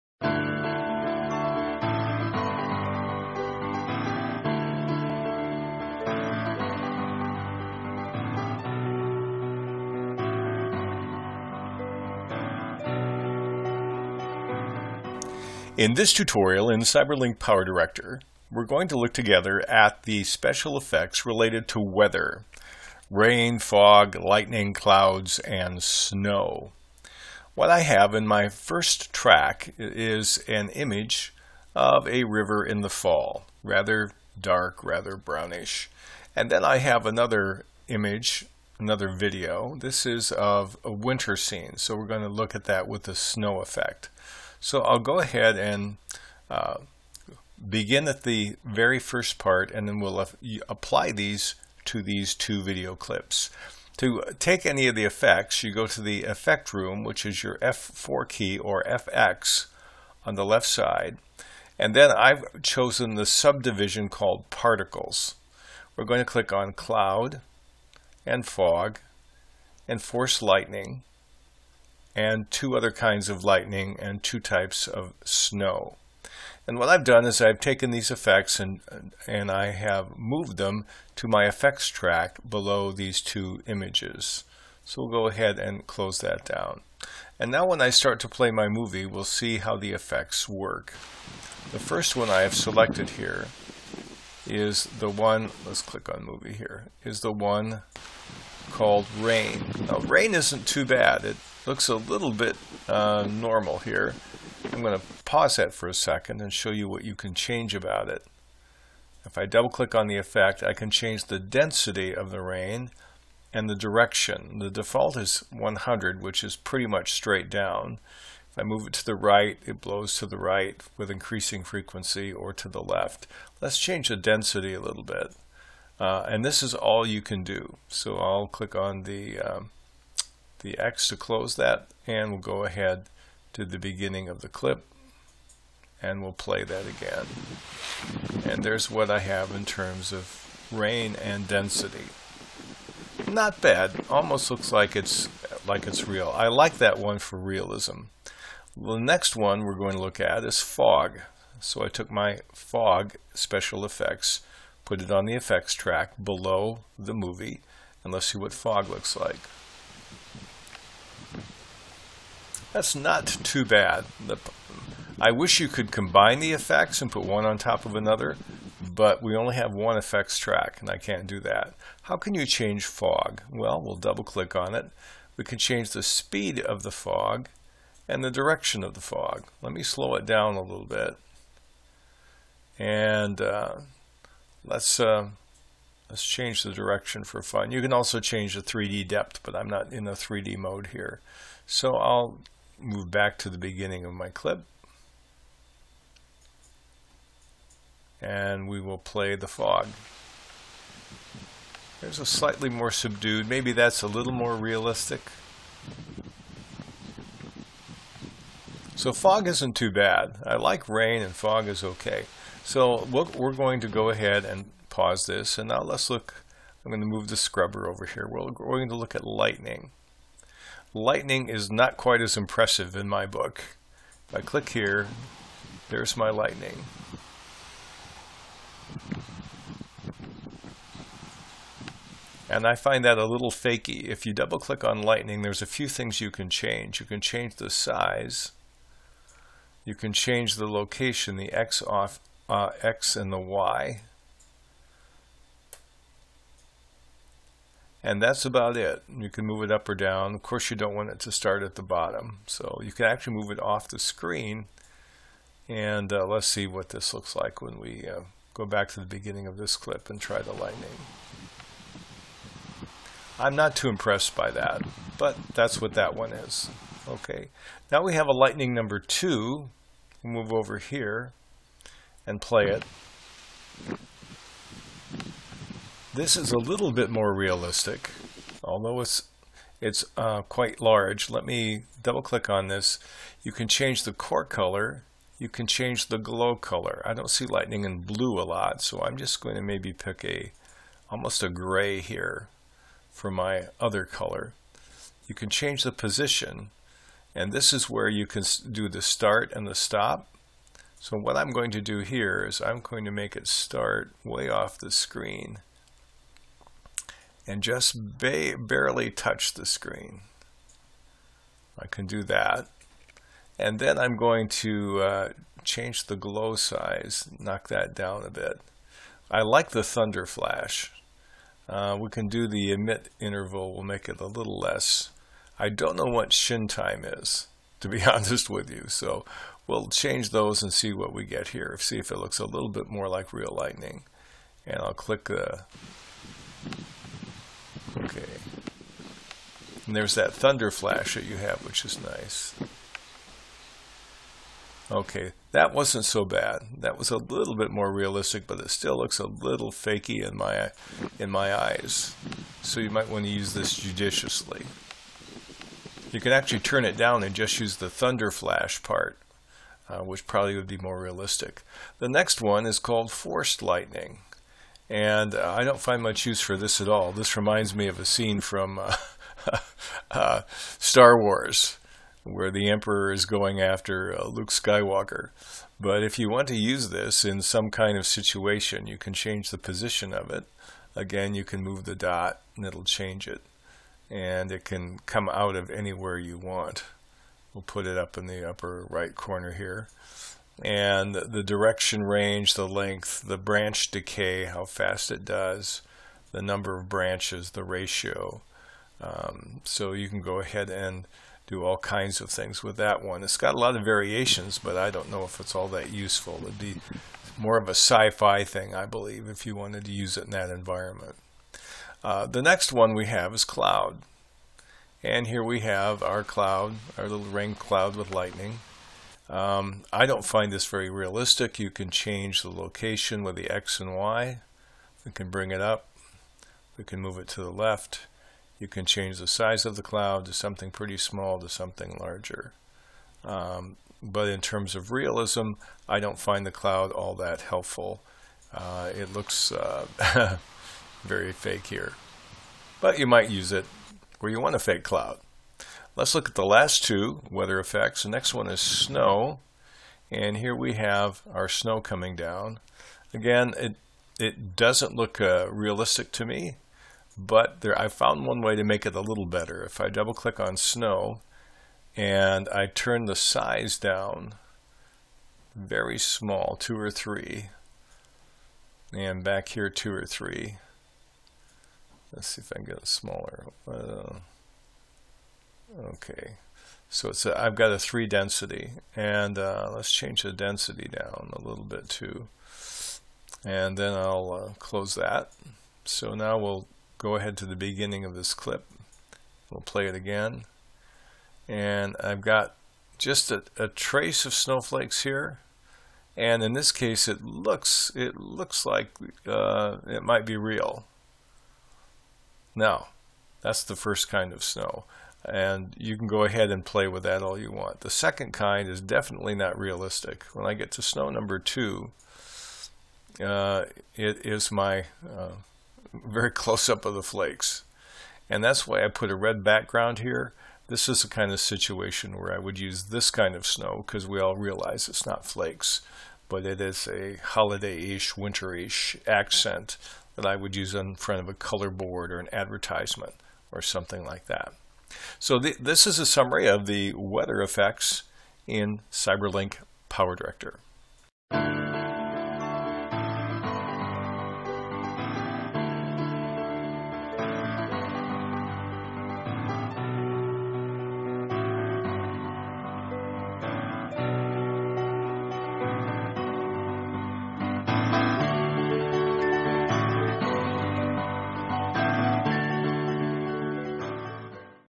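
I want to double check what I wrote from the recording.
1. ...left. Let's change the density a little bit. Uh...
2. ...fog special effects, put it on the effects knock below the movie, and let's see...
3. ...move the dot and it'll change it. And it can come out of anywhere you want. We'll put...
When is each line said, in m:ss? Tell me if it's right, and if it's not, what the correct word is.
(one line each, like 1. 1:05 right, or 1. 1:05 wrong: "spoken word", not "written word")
1. 2:02 right
2. 2:32 wrong: "track", not "knock"
3. 6:21 right.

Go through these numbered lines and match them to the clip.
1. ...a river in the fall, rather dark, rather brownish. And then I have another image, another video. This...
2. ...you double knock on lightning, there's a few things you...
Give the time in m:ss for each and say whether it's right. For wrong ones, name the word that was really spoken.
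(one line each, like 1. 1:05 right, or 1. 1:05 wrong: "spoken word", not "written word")
1. 0:32 right
2. 3:54 wrong: "click", not "knock".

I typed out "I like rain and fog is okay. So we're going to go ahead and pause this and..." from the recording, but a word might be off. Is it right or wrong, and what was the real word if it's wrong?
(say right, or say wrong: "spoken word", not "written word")
right.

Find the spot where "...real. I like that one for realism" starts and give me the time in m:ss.
2:26.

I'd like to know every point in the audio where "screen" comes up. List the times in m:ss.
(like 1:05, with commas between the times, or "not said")
4:13, 5:04, 5:09.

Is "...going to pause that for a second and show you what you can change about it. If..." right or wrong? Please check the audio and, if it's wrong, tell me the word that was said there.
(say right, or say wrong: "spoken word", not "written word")
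right.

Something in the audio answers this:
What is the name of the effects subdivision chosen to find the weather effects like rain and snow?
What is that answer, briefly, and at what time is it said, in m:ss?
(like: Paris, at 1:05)
particles, at 1:04.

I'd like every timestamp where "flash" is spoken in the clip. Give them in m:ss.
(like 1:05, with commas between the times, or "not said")
5:20, 5:40, 5:58.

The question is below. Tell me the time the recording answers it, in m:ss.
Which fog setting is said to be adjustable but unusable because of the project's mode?
3:08.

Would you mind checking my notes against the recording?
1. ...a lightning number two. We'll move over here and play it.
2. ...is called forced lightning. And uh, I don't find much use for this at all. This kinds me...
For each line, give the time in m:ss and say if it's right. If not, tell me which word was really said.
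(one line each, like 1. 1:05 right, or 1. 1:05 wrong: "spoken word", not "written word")
1. 4:28 right
2. 6:02 wrong: "reminds", not "kinds".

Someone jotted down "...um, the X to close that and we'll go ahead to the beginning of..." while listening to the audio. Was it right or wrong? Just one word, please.
right.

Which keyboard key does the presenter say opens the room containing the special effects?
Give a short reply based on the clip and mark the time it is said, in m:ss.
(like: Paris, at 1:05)
F4, at 0:57.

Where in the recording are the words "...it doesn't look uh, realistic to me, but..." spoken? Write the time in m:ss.
7:34.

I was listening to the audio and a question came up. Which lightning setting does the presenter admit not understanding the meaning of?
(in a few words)
shin time.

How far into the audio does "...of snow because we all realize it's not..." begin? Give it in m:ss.
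8:43.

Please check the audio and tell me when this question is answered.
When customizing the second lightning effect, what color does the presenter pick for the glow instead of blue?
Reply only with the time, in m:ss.
4:51.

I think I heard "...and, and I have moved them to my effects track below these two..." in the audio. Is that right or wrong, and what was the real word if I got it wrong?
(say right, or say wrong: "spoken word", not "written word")
right.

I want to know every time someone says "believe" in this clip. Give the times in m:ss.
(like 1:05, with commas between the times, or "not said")
6:48.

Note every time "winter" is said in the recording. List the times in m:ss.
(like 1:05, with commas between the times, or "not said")
0:40, 8:48.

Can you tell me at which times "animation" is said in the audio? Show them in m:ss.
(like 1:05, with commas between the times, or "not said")
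not said.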